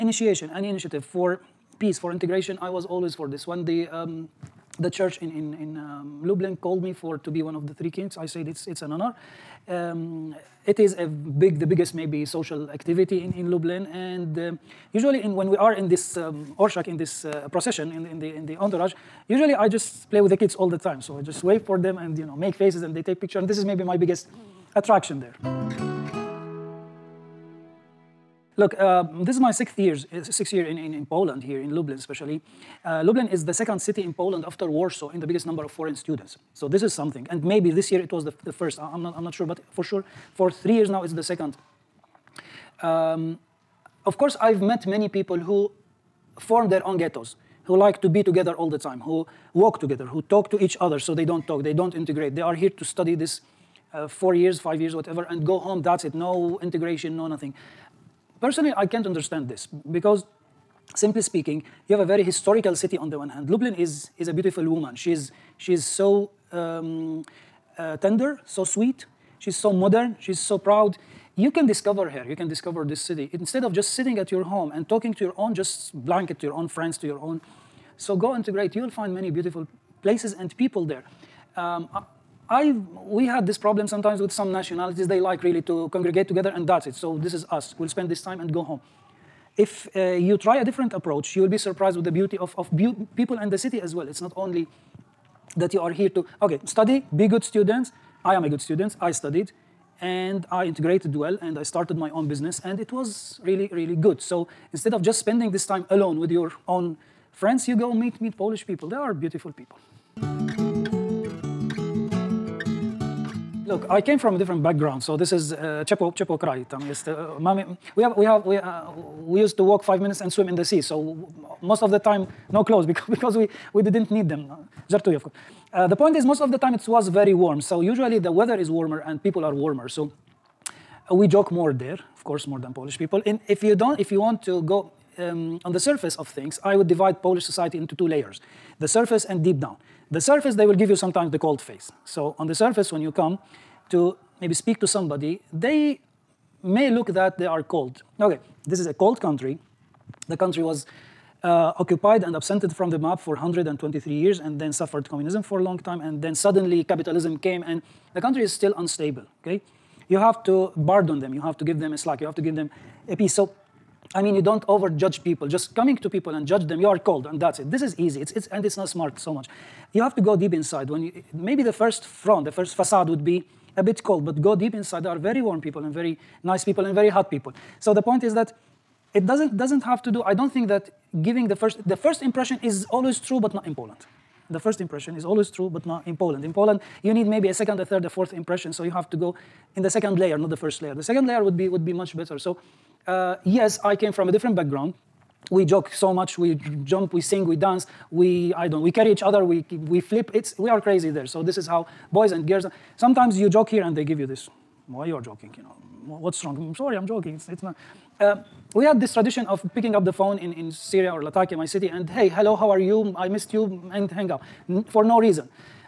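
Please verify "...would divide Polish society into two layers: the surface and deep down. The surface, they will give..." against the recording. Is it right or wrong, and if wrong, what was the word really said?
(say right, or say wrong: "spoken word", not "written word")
right.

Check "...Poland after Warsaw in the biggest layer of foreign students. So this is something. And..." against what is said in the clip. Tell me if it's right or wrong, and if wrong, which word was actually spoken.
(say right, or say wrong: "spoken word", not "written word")
wrong: "number", not "layer".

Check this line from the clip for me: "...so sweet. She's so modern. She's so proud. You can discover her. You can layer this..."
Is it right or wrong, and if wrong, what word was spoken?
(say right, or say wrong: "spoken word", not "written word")
wrong: "discover", not "layer".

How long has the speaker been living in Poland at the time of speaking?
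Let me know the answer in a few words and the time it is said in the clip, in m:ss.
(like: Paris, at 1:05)
6 years, at 0:30.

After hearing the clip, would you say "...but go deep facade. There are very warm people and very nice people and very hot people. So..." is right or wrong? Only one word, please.
wrong.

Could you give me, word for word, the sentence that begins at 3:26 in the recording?
I'm mm, sorry, I'm joking, it's, it's not.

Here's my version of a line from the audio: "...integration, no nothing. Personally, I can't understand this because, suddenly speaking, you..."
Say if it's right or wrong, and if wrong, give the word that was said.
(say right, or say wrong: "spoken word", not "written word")
wrong: "simply", not "suddenly".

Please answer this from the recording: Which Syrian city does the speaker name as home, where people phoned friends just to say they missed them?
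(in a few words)
Latakia.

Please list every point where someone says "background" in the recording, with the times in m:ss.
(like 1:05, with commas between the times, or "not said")
1:54, 3:14.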